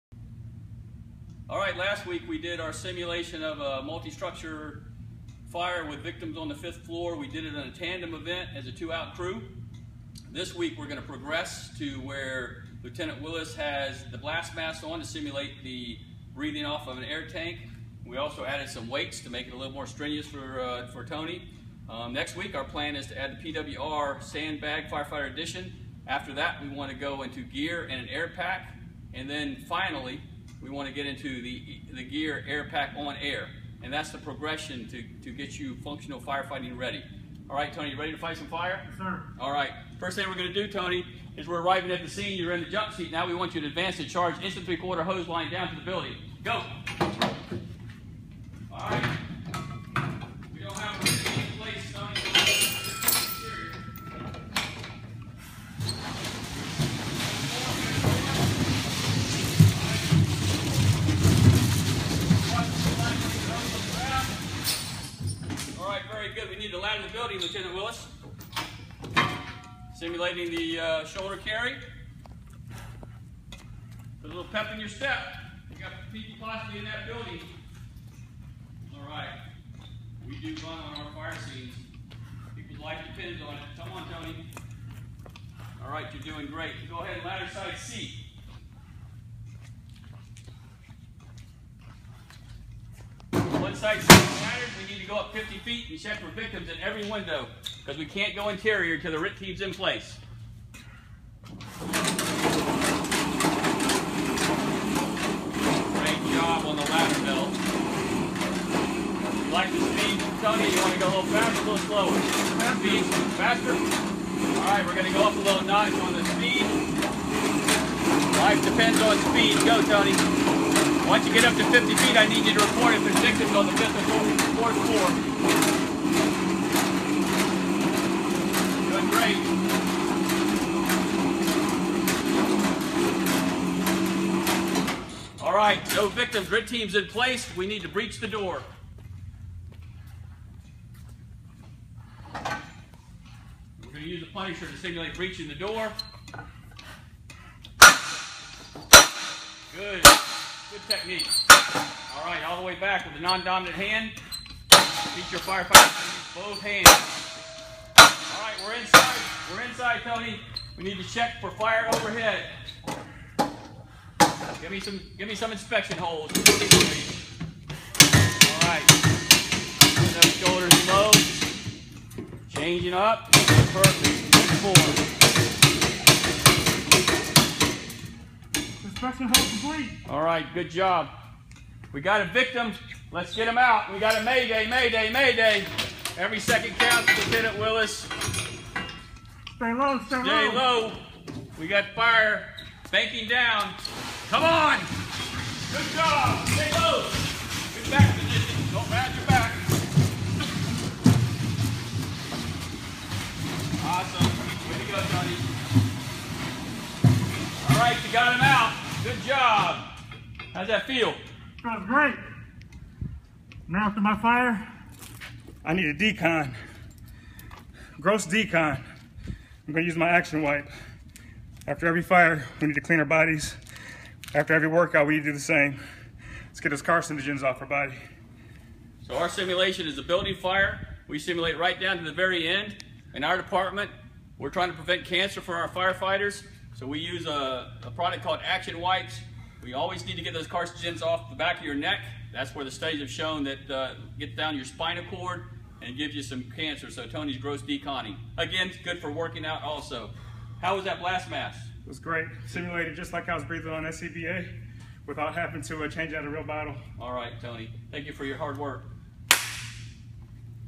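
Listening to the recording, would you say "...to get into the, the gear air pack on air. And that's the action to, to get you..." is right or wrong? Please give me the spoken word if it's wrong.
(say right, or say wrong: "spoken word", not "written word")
wrong: "progression", not "action".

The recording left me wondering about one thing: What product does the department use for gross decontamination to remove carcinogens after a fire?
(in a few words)
Action Wipes.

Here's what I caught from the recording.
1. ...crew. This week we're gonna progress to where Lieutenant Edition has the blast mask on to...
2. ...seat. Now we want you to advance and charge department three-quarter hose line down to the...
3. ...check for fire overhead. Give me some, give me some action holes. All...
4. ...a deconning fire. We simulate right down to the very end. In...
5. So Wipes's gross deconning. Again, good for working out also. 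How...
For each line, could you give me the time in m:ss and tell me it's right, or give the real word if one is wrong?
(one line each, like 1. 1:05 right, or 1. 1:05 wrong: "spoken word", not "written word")
1. 0:09 wrong: "Willis", not "Edition"
2. 0:42 wrong: "instant", not "department"
3. 2:41 wrong: "inspection", not "action"
4. 3:49 wrong: "building", not "deconning"
5. 4:06 wrong: "Tony", not "Wipes".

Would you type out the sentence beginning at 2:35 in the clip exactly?
Teach your firefighters to use both hands.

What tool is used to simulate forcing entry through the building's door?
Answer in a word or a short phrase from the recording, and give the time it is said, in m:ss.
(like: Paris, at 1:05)
punisher, at 2:24.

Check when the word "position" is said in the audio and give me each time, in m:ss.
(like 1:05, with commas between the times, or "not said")
3:18.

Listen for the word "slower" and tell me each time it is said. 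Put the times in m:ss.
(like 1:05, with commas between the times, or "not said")
1:51.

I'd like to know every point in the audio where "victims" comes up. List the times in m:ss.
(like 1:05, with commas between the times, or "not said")
0:05, 1:36, 2:03, 2:16, 3:02.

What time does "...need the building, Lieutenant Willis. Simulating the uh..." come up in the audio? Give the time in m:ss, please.
1:06.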